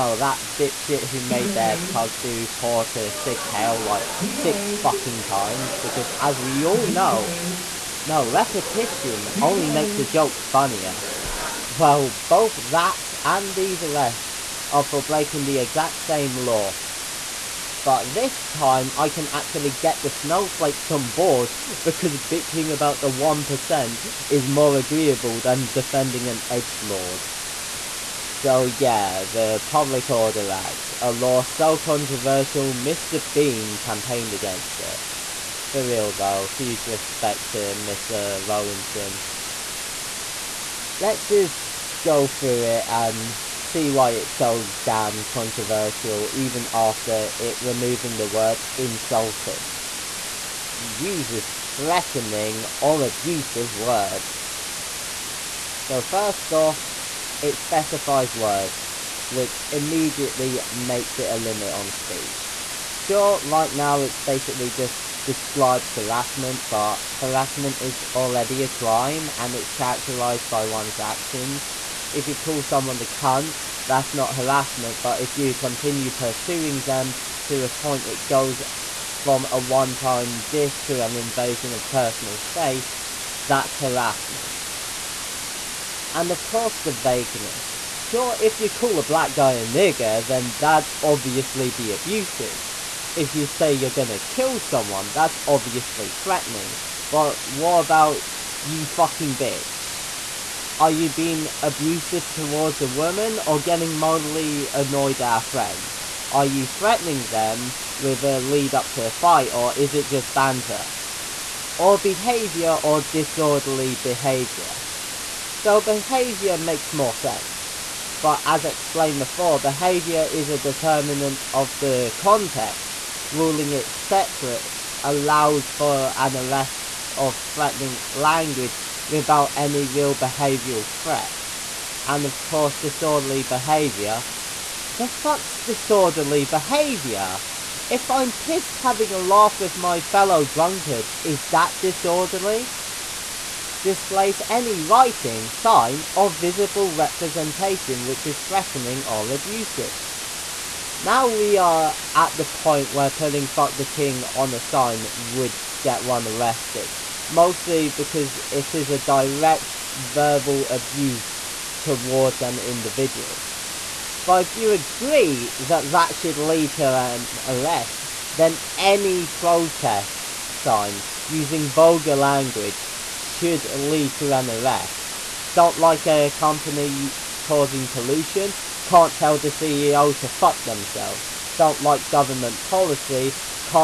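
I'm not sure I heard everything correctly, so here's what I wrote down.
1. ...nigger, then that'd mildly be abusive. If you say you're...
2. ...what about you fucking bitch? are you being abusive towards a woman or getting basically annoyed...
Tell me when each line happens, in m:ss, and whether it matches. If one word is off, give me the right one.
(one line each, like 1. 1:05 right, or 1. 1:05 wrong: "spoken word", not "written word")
1. 1:29 wrong: "obviously", not "mildly"
2. 1:37 wrong: "mildly", not "basically".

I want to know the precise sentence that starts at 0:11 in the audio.
Well, both that and these arrests are for breaking the exact same law.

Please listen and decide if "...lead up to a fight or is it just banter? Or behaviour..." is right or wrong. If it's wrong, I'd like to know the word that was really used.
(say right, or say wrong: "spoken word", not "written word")
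right.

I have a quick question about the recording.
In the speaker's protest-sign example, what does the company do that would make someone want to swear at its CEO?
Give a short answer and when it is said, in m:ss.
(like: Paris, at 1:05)
pollution, at 2:57.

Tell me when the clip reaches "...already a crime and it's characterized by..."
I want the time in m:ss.
1:08.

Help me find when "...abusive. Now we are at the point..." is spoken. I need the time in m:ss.
2:29.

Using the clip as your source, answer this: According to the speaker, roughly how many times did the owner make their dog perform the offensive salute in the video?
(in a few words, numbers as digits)
6.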